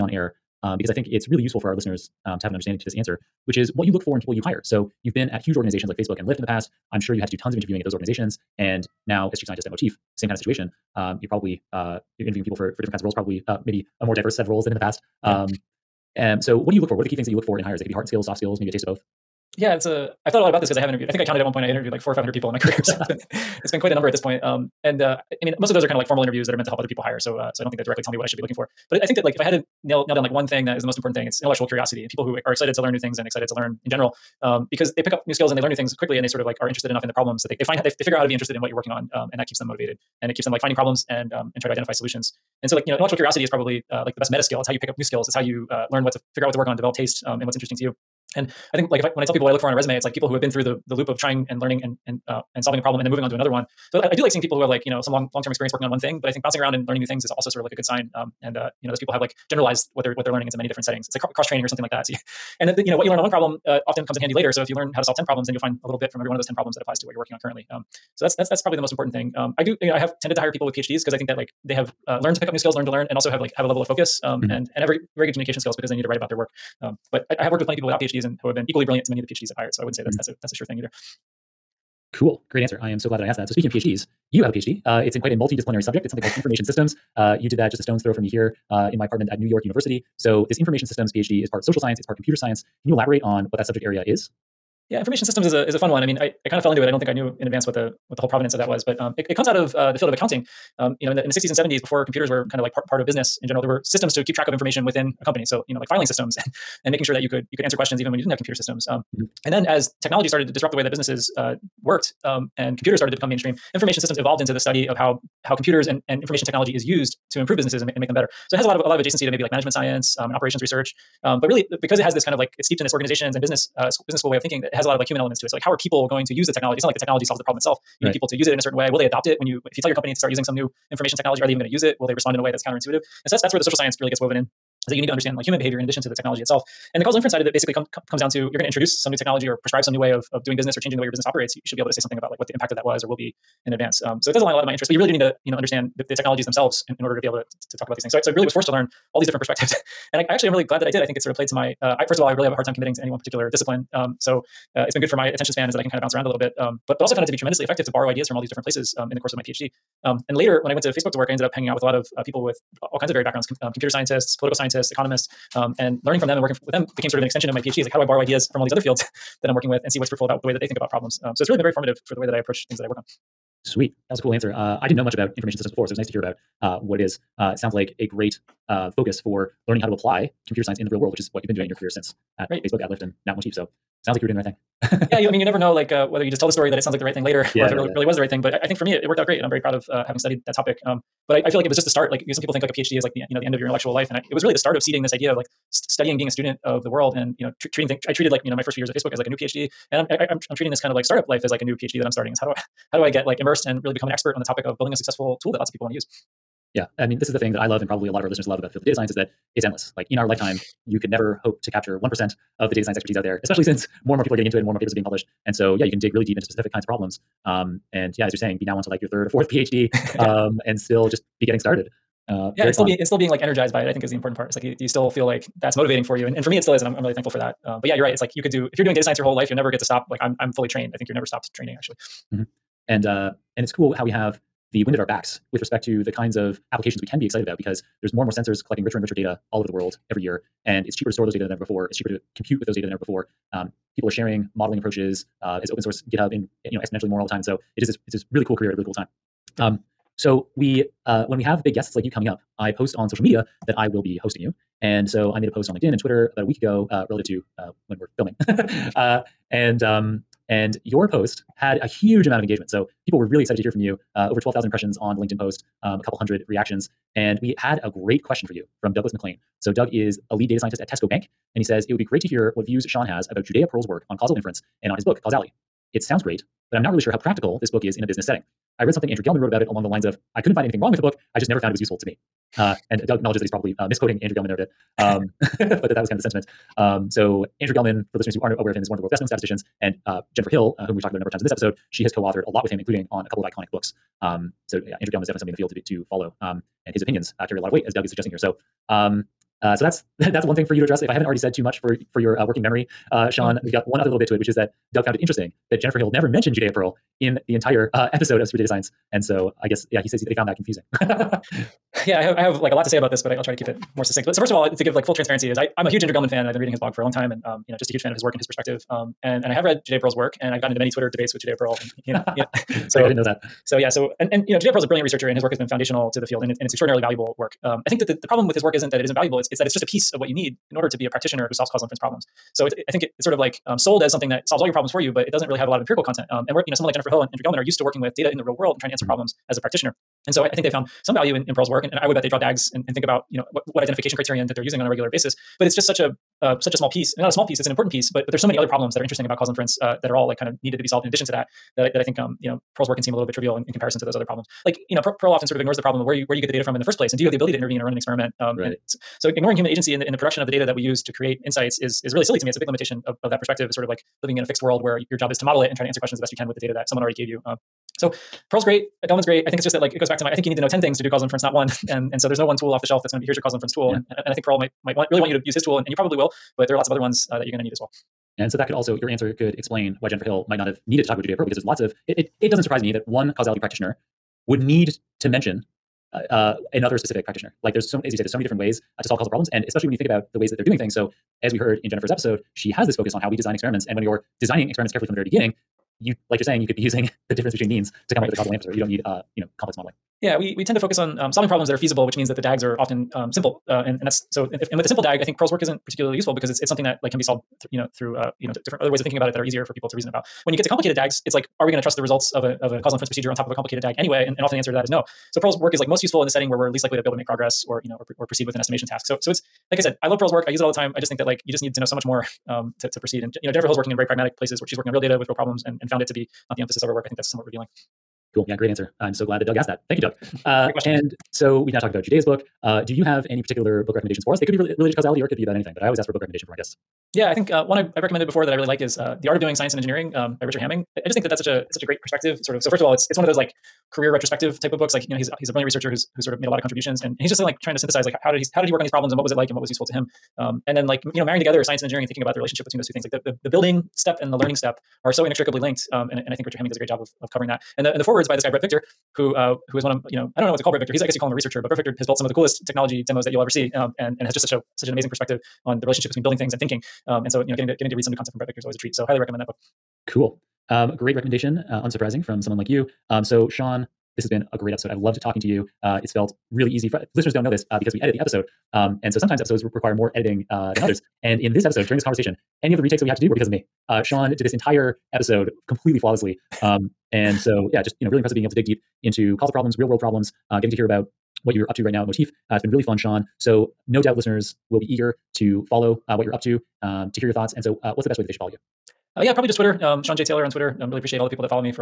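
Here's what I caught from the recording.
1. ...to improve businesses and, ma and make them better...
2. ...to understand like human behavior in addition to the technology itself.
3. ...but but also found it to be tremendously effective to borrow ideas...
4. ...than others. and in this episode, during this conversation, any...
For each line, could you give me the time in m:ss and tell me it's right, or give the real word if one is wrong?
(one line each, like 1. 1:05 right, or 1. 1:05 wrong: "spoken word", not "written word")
1. 1:57 right
2. 2:15 right
3. 2:36 right
4. 8:00 right.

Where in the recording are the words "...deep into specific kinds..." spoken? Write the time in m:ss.
3:36.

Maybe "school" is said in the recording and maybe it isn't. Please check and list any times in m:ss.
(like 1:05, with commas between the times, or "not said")
2:04.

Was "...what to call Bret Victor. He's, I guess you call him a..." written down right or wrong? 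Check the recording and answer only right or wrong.
right.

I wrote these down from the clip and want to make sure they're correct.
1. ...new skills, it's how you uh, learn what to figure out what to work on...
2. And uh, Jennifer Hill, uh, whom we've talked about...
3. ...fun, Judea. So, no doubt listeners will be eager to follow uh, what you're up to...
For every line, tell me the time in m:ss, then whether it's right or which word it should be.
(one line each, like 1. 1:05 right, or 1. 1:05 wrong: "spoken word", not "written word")
1. 0:44 right
2. 4:49 right
3. 8:12 wrong: "Sean", not "Judea".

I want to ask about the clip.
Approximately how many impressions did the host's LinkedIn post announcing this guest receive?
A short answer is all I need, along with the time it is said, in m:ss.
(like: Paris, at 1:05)
12,000, at 4:24.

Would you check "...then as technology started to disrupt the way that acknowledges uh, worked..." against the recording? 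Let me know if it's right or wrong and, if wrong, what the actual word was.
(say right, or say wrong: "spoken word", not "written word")
wrong: "businesses", not "acknowledges".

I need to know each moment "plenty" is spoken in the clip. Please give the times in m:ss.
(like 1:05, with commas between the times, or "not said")
1:17.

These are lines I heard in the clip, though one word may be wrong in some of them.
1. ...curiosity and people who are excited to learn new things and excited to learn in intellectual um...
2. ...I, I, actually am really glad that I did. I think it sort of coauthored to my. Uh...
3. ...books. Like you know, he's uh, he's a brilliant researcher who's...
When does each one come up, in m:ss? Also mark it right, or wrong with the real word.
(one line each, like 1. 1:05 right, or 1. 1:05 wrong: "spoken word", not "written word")
1. 0:31 wrong: "general", not "intellectual"
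2. 2:30 wrong: "played", not "coauthored"
3. 7:24 right.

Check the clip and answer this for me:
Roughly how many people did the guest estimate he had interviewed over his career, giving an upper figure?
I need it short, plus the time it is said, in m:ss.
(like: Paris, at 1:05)
500, at 0:22.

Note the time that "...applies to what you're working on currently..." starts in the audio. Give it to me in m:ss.
1:06.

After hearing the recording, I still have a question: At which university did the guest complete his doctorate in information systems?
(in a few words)
New York University.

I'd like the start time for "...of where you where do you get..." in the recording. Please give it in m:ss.
5:55.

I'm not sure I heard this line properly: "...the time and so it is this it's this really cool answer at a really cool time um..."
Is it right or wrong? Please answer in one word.
wrong.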